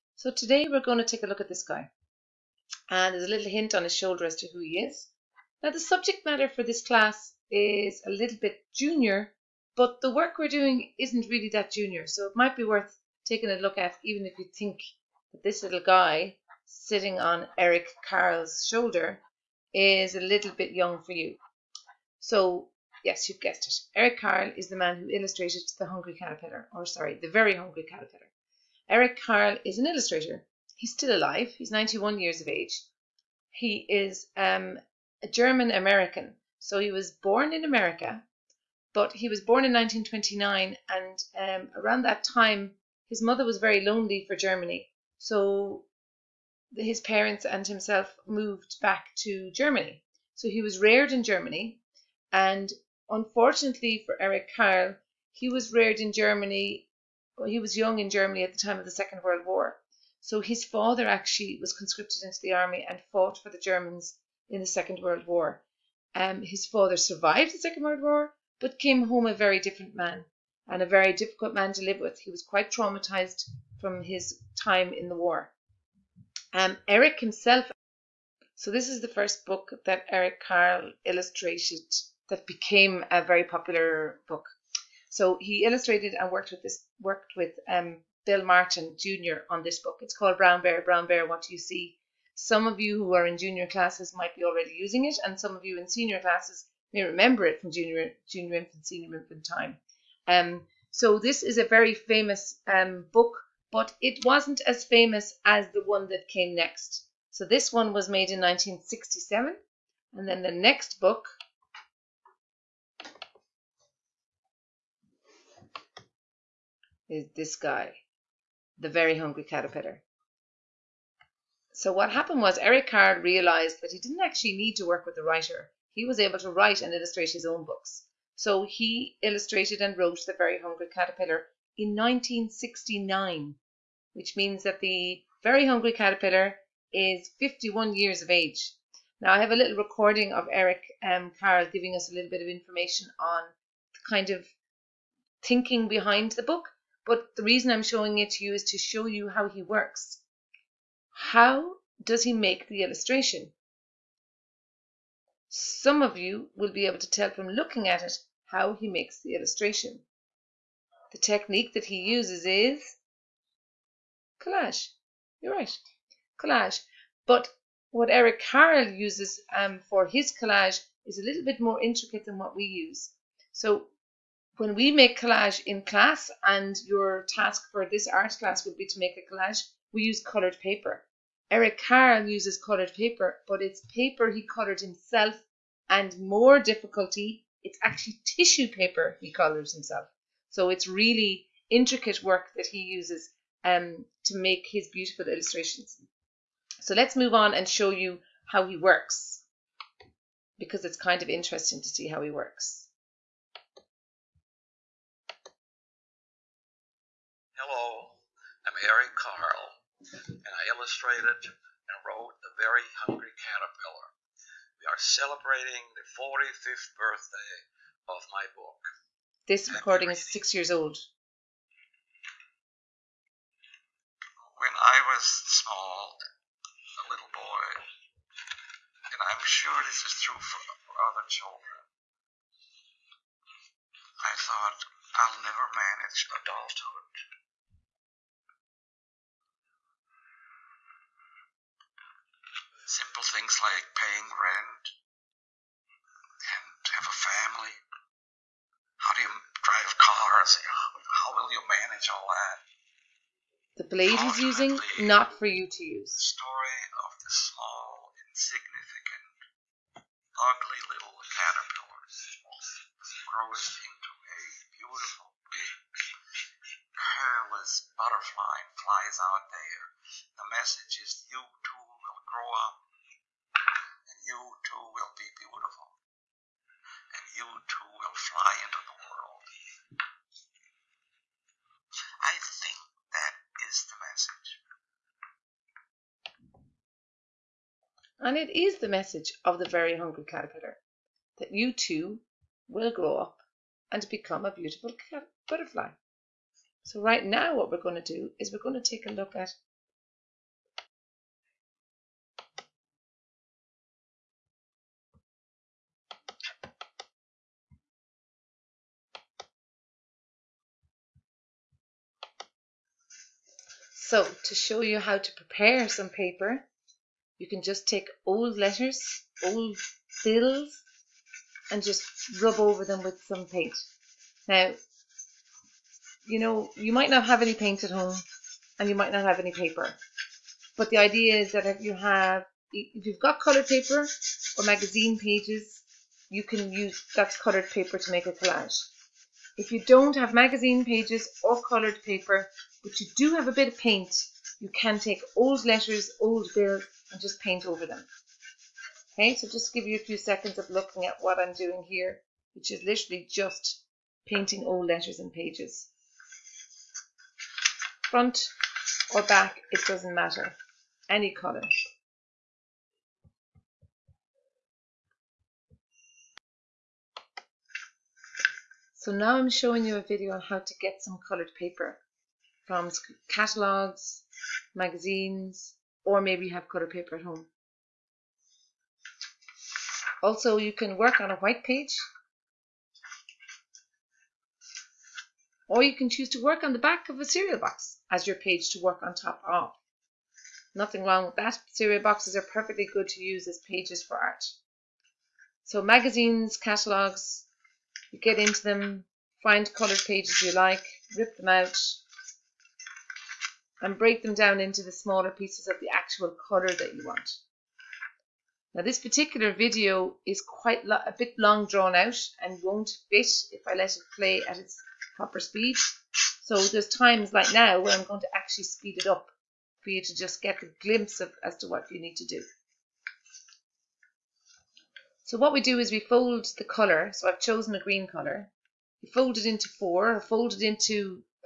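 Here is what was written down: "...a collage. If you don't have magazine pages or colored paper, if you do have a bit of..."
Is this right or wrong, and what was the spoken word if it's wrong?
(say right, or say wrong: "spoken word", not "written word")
right.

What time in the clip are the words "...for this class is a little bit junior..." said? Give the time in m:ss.
0:06.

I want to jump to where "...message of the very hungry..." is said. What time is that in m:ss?
4:48.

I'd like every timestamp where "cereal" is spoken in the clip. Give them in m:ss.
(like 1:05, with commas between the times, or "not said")
6:27, 6:31.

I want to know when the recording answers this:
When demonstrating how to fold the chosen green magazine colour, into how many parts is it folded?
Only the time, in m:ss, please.
7:09.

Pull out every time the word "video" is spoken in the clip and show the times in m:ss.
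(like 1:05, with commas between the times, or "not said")
6:10, 6:49.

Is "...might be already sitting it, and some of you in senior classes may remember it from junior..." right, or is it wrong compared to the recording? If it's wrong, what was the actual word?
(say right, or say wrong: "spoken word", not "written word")
wrong: "using", not "sitting".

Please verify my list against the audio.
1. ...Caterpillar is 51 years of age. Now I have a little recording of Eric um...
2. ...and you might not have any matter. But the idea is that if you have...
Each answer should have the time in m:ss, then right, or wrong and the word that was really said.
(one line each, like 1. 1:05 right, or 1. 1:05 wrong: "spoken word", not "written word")
1. 2:15 right
2. 5:28 wrong: "paper", not "matter".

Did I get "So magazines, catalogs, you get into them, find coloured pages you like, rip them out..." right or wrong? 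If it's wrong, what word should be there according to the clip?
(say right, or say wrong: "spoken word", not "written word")
right.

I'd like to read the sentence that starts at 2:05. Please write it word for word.
He was able to write and illustrate his own books.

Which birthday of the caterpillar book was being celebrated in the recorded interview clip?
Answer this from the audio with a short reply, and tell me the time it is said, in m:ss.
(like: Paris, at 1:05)
45th, at 3:36.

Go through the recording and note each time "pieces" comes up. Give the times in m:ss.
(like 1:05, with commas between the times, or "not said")
6:45.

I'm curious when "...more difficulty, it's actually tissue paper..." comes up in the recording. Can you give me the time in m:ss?
3:06.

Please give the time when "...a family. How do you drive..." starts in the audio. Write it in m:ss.
4:07.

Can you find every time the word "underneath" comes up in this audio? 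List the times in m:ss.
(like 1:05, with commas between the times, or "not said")
not said.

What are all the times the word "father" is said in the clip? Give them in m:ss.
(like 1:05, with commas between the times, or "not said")
1:00, 1:06.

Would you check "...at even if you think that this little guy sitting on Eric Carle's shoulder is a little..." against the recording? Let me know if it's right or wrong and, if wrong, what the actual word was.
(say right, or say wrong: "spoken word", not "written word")
right.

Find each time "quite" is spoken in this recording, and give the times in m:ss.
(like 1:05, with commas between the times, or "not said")
1:12, 6:50.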